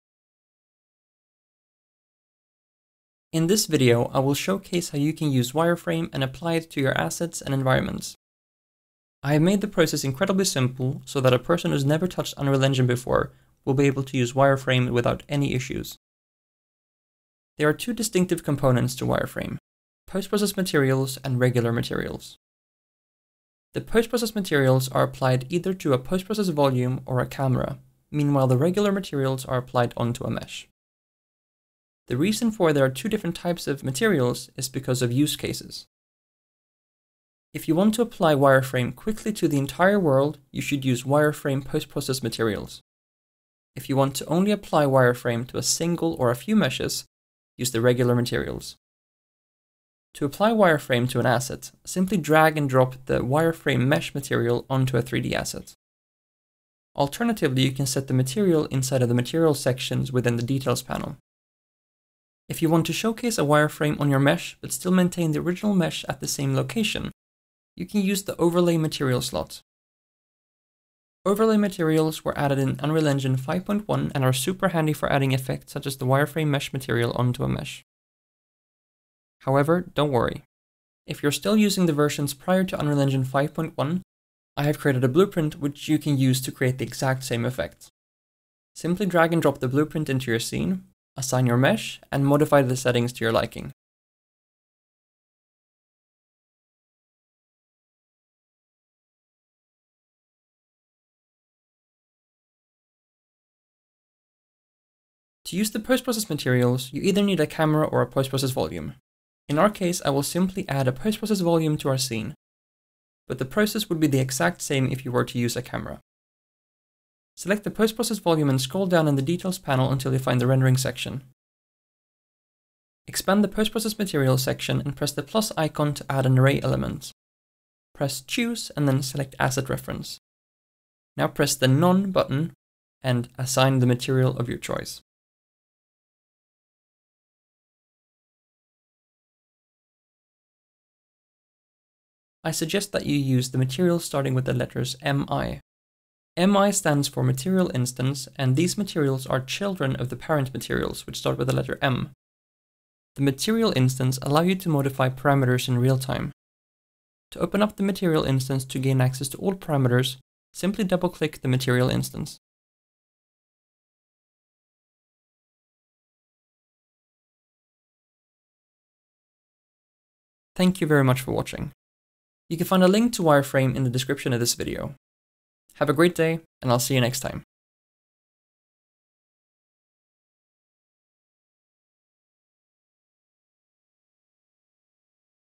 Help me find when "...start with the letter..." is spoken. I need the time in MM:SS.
02:31.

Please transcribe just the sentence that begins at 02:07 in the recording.
Press Choose and then select Asset Reference.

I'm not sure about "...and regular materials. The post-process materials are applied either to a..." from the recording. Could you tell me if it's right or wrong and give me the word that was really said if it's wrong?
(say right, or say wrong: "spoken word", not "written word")
right.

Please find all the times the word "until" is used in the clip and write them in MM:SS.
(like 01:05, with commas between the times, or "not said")
01:59.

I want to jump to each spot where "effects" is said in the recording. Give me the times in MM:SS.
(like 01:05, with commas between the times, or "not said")
01:15, 01:27.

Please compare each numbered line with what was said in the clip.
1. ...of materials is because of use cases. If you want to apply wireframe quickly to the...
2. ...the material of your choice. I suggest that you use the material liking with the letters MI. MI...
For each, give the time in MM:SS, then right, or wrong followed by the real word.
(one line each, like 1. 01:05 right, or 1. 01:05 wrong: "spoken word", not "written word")
1. 00:33 right
2. 02:13 wrong: "starting", not "liking".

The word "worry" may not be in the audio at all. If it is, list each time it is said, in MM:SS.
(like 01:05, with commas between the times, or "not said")
01:20.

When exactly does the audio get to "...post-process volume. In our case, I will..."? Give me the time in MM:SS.
01:48.